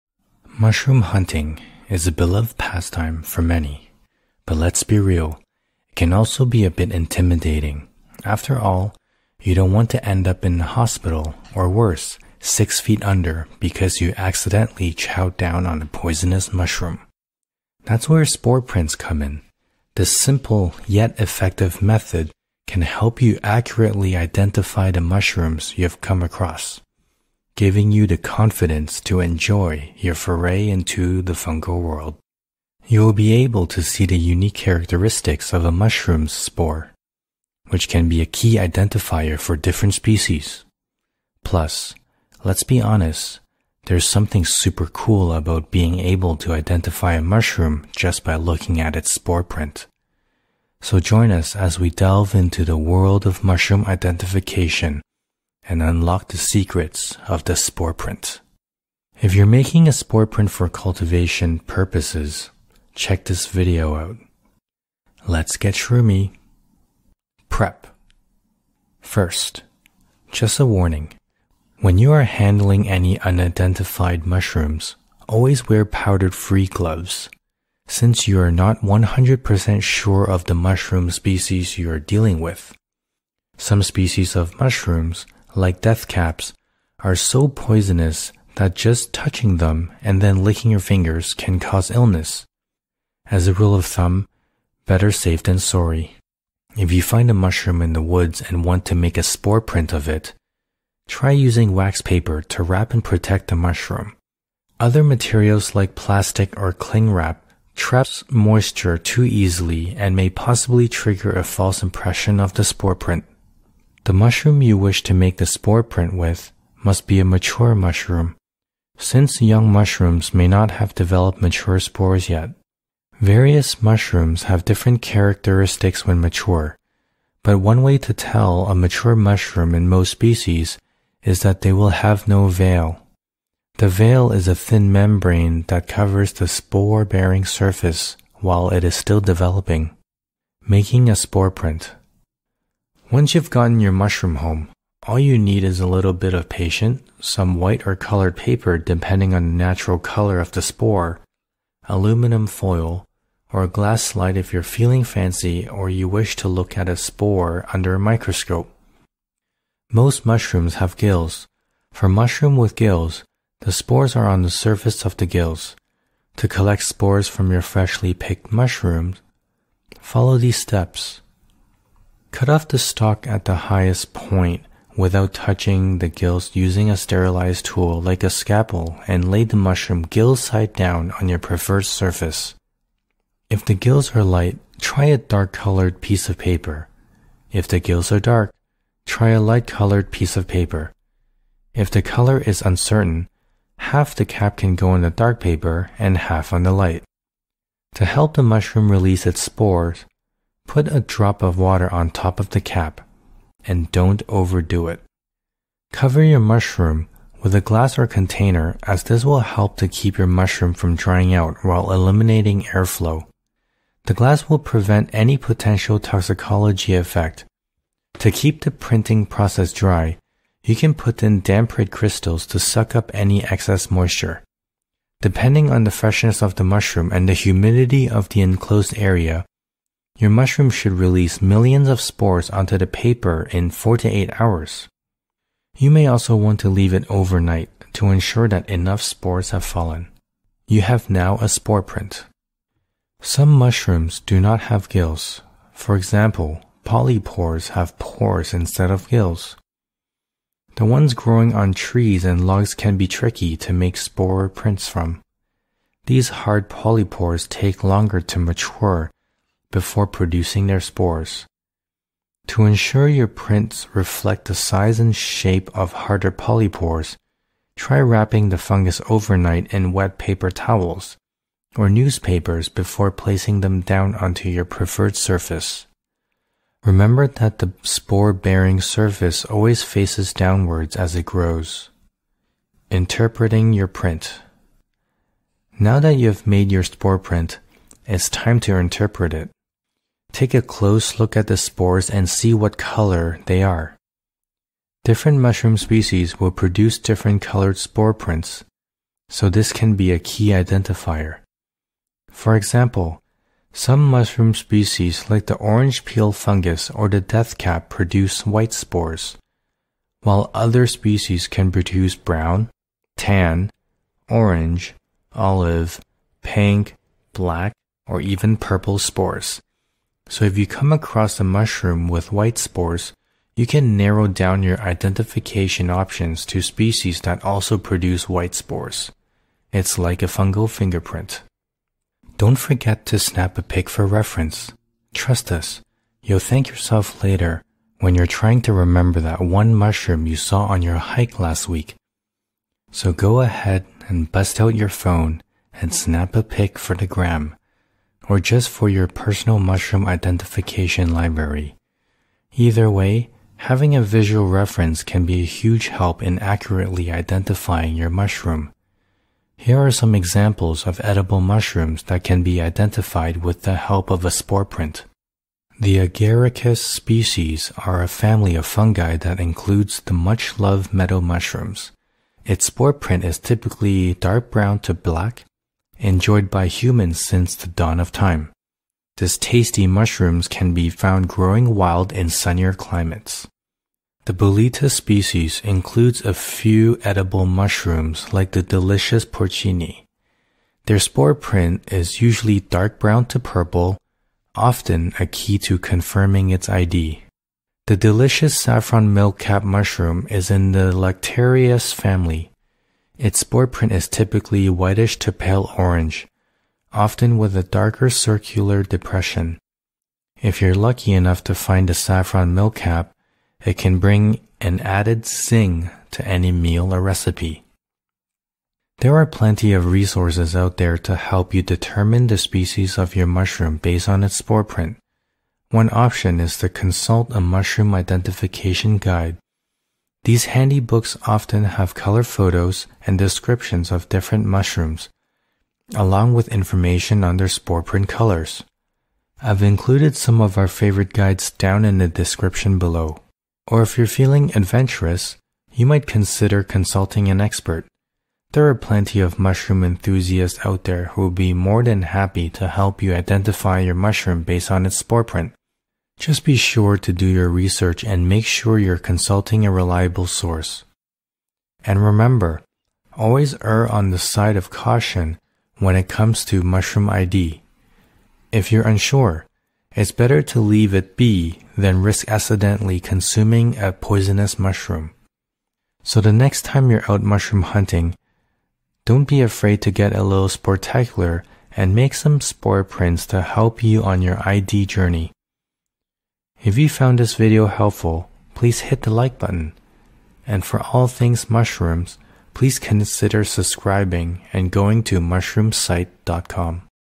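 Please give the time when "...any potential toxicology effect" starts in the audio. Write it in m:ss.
3:35.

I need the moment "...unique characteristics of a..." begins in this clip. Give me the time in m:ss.
0:34.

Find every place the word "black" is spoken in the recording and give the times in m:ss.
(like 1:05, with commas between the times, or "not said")
5:17, 6:14.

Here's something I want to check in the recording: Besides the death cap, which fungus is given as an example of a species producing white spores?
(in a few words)
orange peel fungus.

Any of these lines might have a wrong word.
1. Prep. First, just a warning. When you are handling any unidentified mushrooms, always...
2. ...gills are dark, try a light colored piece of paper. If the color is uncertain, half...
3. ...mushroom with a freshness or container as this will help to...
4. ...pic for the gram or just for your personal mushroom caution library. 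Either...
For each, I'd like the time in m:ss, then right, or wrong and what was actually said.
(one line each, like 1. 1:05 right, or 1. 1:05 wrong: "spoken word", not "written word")
1. 1:07 right
2. 3:07 right
3. 3:26 wrong: "glass", not "freshness"
4. 5:46 wrong: "identification", not "caution".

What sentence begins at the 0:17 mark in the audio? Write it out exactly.
That's where spore prints come in.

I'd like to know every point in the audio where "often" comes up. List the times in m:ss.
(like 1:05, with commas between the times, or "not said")
6:34, 6:46, 7:11.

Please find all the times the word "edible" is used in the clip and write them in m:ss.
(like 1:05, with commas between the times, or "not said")
6:01, 6:27.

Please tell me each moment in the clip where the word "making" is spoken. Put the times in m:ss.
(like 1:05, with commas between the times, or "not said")
0:59, 2:20.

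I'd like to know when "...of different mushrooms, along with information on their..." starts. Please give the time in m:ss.
7:13.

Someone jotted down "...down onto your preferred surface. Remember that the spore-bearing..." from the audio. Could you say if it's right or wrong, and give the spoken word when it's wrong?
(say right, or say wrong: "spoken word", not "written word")
right.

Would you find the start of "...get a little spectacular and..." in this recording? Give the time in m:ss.
7:59.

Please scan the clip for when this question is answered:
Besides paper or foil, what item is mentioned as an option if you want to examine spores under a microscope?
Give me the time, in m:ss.
2:33.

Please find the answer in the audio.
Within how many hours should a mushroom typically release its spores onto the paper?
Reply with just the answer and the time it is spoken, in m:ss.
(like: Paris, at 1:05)
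4 to 8 hours, at 3:53.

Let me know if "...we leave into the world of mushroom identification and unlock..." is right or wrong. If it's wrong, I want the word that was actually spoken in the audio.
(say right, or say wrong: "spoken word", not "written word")
wrong: "delve", not "leave".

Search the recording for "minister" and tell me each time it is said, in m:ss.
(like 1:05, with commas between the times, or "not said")
not said.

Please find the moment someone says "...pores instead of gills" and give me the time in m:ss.
4:07.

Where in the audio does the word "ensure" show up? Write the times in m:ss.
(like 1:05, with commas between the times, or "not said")
3:58, 4:22.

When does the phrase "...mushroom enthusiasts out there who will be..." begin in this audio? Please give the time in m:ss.
7:29.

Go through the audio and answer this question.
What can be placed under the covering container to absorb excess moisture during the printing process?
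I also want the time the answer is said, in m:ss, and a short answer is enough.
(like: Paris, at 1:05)
damp crystals, at 3:41.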